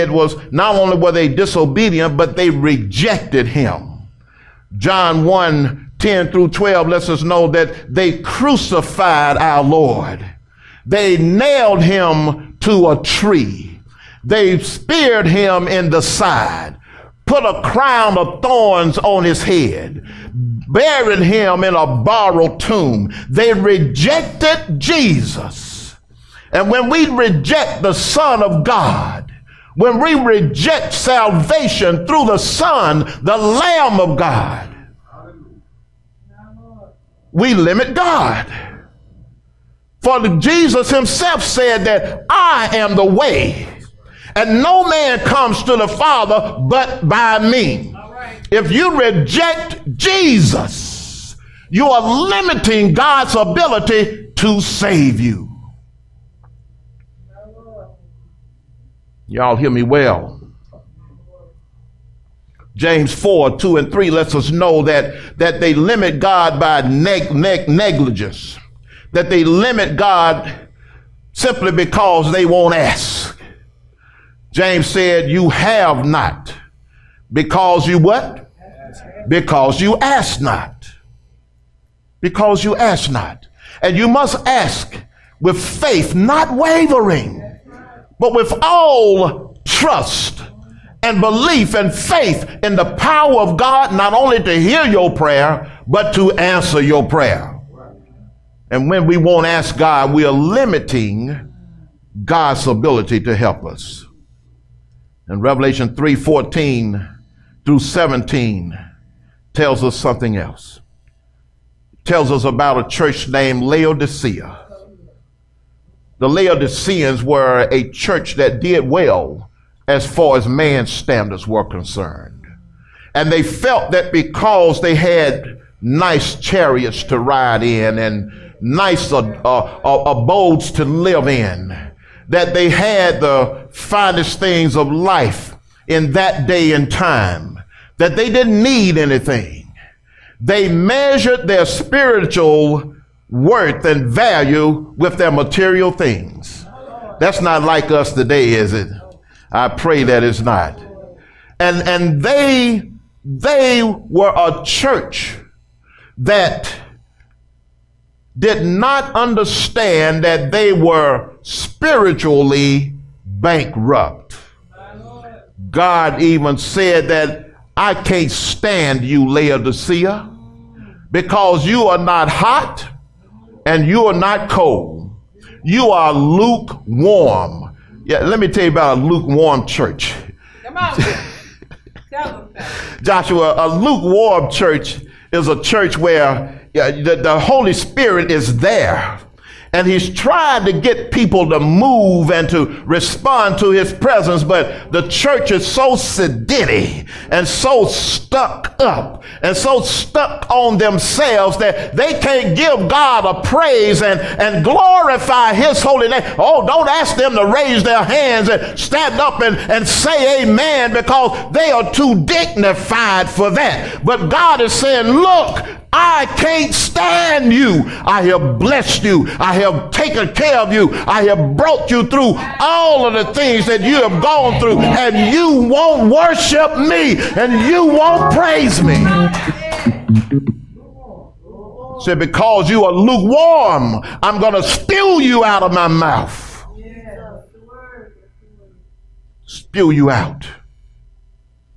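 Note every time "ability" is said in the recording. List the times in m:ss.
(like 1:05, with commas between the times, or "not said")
0:53, 1:42.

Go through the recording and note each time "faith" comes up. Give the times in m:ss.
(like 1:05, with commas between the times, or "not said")
1:25, 1:31.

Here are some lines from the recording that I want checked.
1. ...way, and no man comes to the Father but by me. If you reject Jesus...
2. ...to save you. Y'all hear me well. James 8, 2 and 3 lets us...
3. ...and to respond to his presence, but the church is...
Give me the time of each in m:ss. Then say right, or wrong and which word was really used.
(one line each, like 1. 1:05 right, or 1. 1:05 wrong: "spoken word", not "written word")
1. 0:43 right
2. 0:54 wrong: "4", not "8"
3. 3:12 right.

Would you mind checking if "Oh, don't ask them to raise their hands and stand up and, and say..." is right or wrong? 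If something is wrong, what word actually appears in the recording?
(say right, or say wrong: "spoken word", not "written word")
right.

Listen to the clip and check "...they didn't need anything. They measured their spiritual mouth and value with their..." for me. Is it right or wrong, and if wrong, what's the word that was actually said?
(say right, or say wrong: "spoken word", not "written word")
wrong: "worth", not "mouth".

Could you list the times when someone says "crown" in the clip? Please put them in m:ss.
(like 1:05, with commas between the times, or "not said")
0:17.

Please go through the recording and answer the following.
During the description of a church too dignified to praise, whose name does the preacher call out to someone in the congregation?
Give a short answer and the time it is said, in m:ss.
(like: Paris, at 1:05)
Joshua, at 3:03.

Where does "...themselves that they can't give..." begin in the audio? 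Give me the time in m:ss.
3:20.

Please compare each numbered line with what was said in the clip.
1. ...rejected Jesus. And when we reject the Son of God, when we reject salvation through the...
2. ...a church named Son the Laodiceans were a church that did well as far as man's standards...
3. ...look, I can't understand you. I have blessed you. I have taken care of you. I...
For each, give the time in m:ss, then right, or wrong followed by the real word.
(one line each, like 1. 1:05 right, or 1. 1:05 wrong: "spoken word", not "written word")
1. 0:23 right
2. 1:52 wrong: "Laodicea", not "Son"
3. 3:35 wrong: "stand", not "understand".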